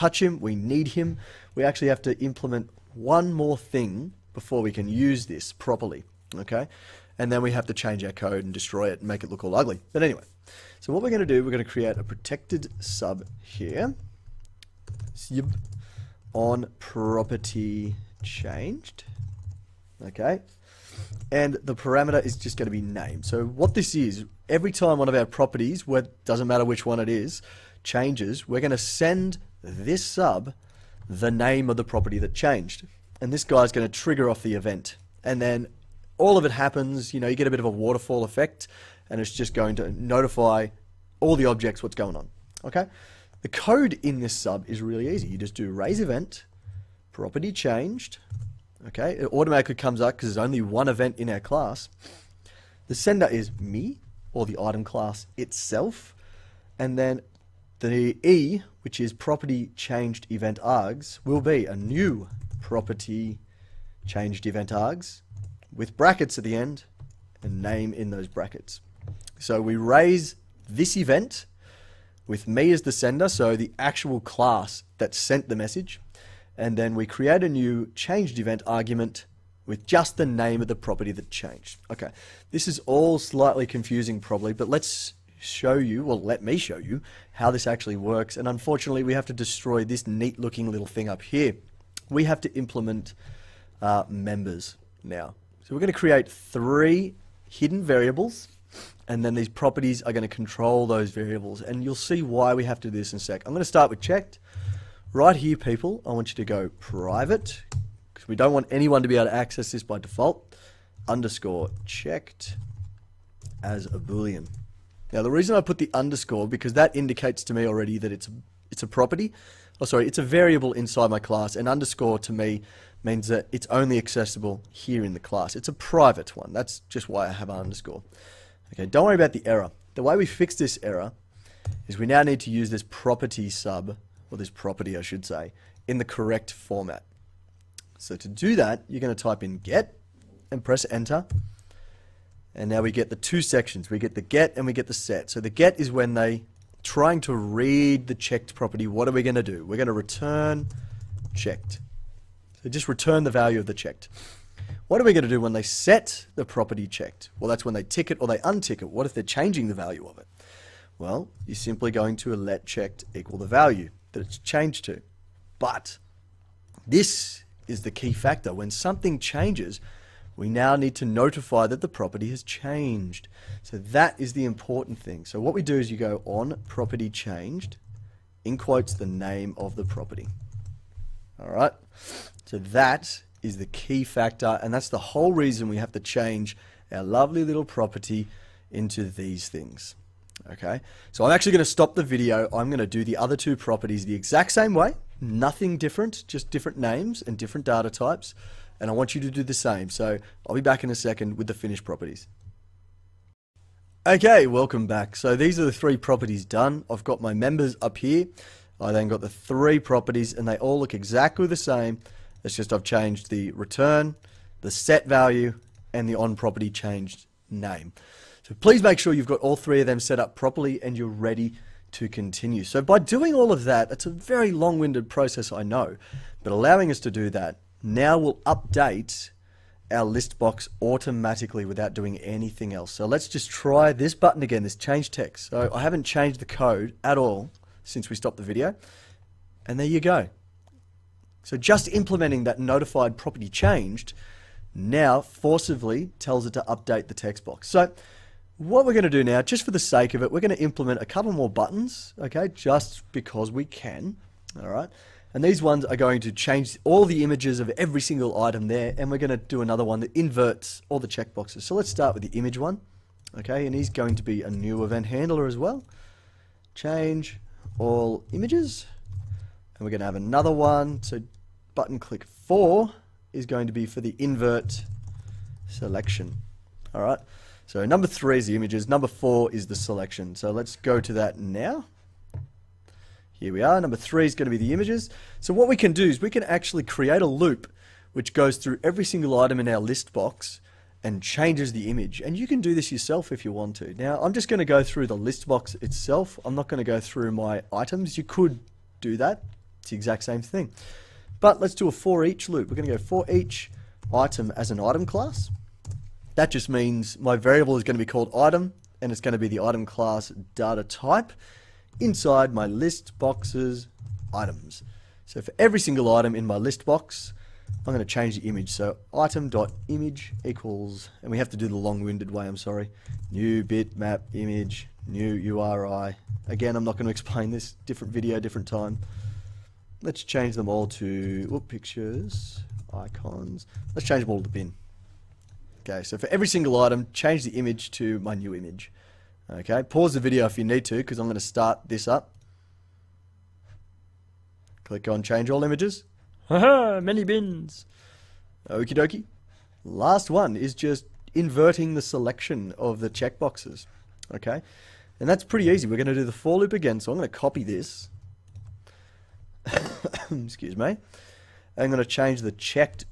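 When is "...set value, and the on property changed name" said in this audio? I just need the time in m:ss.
3:34.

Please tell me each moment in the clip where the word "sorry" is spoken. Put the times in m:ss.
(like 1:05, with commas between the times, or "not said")
1:59, 5:22.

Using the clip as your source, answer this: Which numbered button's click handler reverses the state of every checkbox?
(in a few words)
4.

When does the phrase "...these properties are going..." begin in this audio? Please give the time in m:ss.
1:39.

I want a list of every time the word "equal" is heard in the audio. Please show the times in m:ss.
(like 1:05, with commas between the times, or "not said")
2:43, 5:20.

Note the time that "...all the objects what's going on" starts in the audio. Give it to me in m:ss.
0:41.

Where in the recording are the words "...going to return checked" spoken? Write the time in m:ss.
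2:29.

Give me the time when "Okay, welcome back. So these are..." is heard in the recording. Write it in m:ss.
3:24.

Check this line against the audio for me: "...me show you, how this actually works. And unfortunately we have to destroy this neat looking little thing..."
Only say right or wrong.
right.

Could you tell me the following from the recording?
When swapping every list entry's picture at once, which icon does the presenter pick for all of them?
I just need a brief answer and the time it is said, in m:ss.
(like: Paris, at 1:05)
the bin, at 5:34.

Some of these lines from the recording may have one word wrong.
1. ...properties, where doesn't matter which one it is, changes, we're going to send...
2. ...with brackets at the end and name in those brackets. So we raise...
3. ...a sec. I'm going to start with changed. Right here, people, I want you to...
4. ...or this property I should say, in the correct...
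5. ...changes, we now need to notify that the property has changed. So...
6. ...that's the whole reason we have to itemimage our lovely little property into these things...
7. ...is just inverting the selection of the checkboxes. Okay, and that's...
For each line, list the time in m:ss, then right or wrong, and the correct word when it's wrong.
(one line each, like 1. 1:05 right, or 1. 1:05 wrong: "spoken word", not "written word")
1. 0:25 right
2. 1:05 right
3. 1:43 wrong: "checked", not "changed"
4. 2:14 right
5. 2:49 right
6. 3:04 wrong: "change", not "itemimage"
7. 5:50 right.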